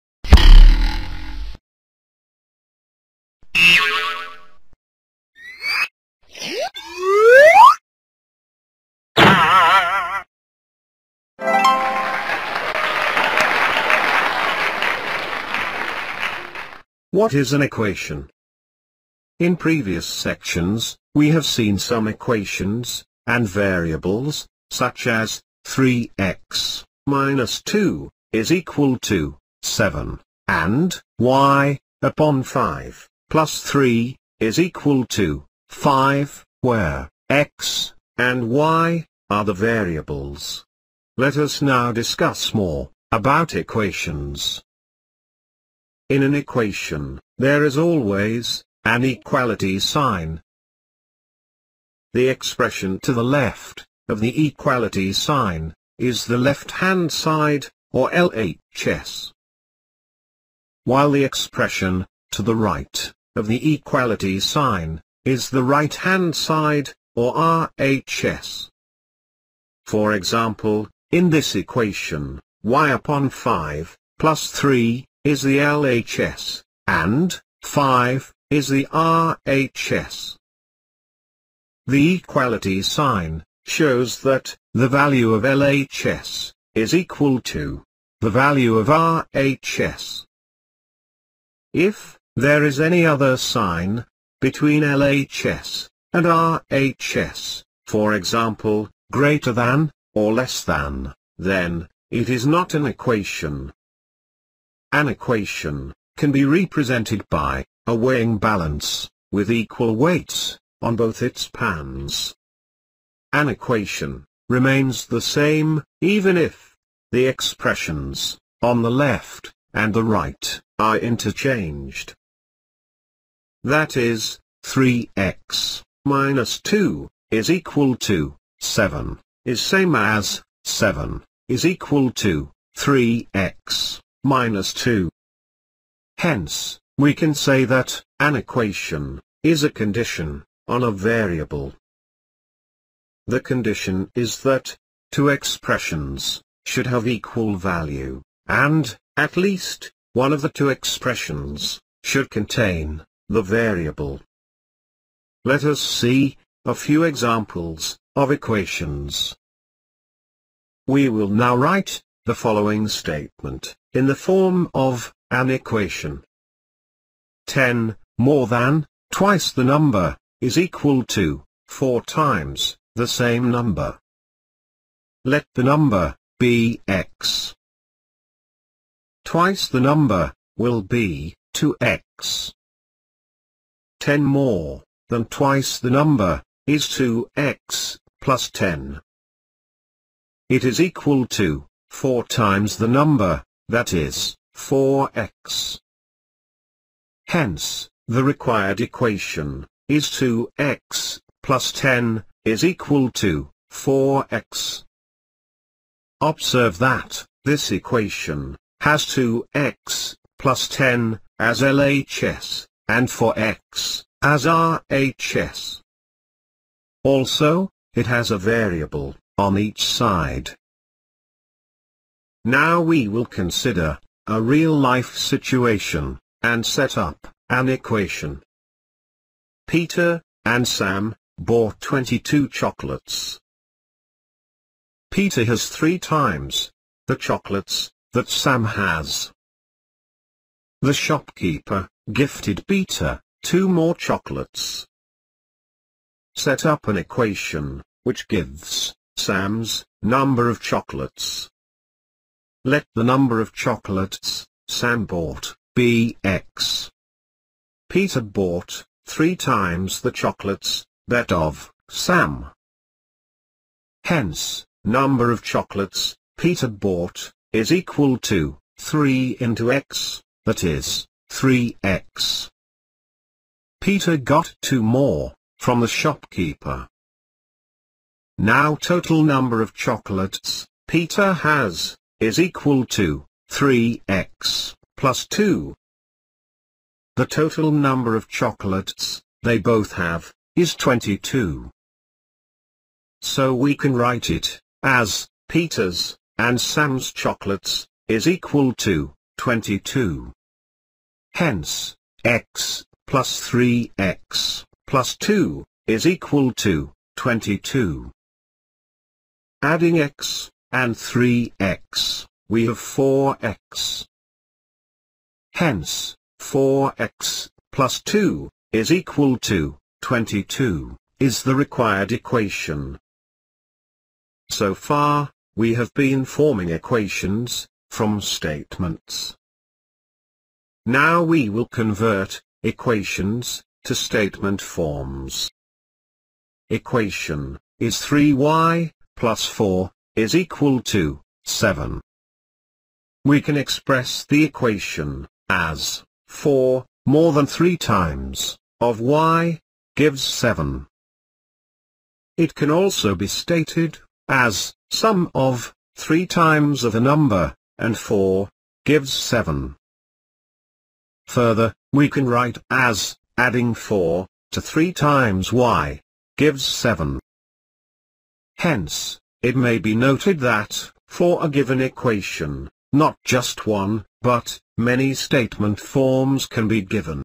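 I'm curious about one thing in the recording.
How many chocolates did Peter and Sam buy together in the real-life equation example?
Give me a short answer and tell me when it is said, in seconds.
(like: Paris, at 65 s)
22, at 231 s.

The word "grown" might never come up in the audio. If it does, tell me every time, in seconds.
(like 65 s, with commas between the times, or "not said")
not said.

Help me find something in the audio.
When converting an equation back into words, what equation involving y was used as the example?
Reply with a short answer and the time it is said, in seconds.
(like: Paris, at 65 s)
3y + 4 = 7, at 338 s.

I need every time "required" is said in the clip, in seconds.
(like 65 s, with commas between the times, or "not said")
198 s, 321 s.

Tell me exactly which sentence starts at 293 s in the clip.
So we can write it, as, Peter's, and Sam's chocolates, is equal to, 22.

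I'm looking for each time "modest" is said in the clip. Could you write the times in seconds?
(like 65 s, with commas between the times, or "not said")
not said.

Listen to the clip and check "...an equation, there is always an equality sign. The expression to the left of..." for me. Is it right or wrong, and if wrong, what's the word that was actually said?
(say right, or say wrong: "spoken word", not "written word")
right.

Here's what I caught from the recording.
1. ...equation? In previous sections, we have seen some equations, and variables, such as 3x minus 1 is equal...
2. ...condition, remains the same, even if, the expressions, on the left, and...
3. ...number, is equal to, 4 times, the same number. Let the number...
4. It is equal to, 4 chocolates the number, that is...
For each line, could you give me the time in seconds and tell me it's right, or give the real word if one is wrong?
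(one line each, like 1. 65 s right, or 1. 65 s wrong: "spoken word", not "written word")
1. 17 s wrong: "2", not "1"
2. 113 s wrong: "equation", not "condition"
3. 169 s right
4. 190 s wrong: "times", not "chocolates".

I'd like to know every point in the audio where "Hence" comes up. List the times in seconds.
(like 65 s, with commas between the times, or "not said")
136 s, 197 s, 264 s, 301 s, 315 s, 368 s.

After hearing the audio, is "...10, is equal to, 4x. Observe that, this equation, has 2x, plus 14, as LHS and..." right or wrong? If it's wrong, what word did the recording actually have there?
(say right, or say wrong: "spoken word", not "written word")
wrong: "10", not "14".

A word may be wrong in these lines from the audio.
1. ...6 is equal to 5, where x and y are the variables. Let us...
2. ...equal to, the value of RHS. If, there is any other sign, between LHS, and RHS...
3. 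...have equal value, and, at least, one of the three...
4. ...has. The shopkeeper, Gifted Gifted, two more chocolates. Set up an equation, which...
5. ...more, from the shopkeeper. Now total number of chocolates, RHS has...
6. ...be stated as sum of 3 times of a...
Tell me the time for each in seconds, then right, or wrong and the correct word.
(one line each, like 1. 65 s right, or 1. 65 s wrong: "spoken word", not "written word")
1. 33 s wrong: "3", not "6"
2. 86 s right
3. 146 s wrong: "two", not "three"
4. 238 s wrong: "Peter", not "Gifted"
5. 274 s wrong: "Peter", not "RHS"
6. 353 s right.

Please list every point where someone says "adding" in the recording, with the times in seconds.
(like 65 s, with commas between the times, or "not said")
309 s, 363 s.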